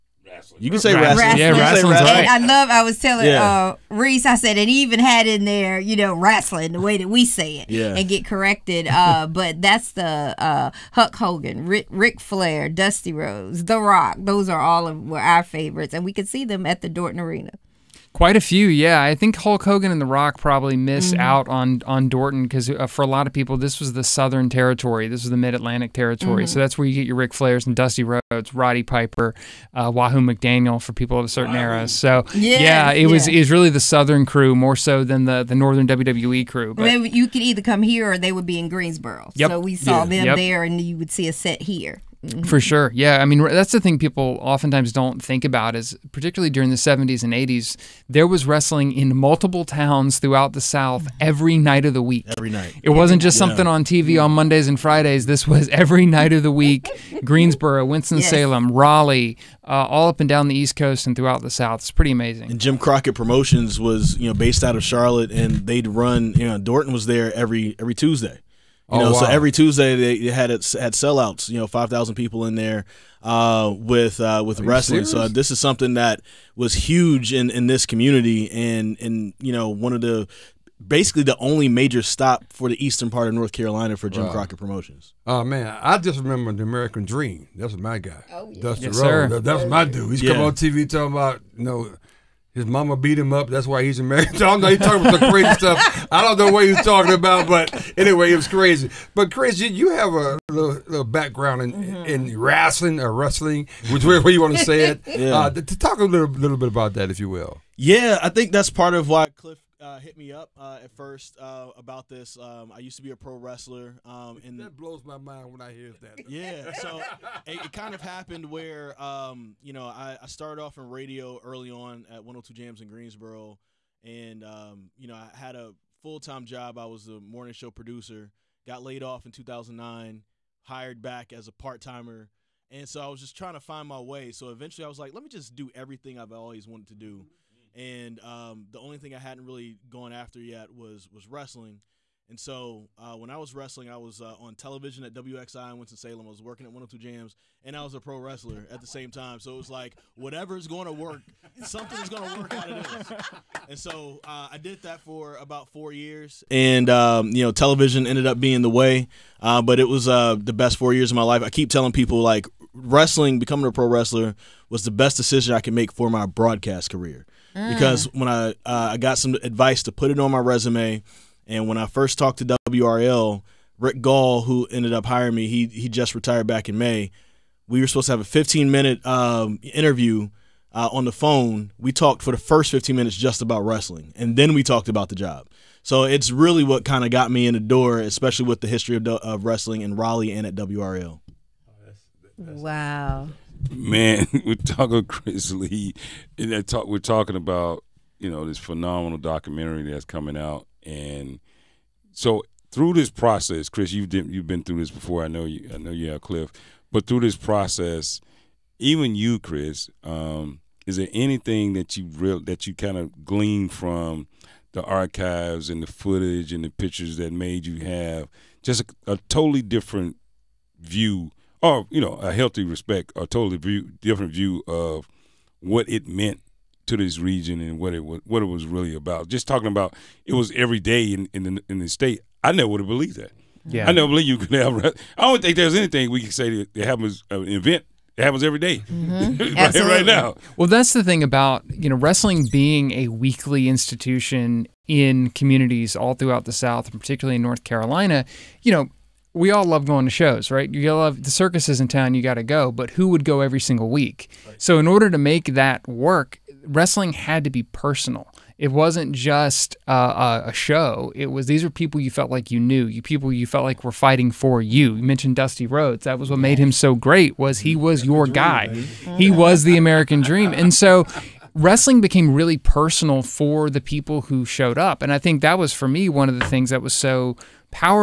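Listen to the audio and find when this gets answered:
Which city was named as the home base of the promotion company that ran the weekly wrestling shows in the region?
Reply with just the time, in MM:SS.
01:04.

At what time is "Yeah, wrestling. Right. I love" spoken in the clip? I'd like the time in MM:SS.
00:01.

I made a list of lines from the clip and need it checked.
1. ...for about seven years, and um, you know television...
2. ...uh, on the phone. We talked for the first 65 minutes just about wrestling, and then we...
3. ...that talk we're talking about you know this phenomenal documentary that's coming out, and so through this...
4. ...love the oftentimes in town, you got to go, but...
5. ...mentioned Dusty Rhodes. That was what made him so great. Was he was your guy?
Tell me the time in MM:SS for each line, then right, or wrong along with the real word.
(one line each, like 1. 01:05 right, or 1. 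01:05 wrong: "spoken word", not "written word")
1. 02:35 wrong: "four", not "seven"
2. 03:00 wrong: "15", not "65"
3. 03:16 right
4. 04:10 wrong: "circuses", not "oftentimes"
5. 04:25 right.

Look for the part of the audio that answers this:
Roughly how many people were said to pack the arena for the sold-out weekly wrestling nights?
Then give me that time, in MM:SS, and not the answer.
01:11.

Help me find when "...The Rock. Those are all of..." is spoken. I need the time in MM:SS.
00:13.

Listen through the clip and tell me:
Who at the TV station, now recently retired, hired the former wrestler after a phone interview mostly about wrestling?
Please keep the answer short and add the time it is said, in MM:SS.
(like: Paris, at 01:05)
Rick Gall, at 02:53.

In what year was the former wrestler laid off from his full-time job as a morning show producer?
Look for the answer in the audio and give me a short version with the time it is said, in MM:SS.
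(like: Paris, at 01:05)
2009, at 02:09.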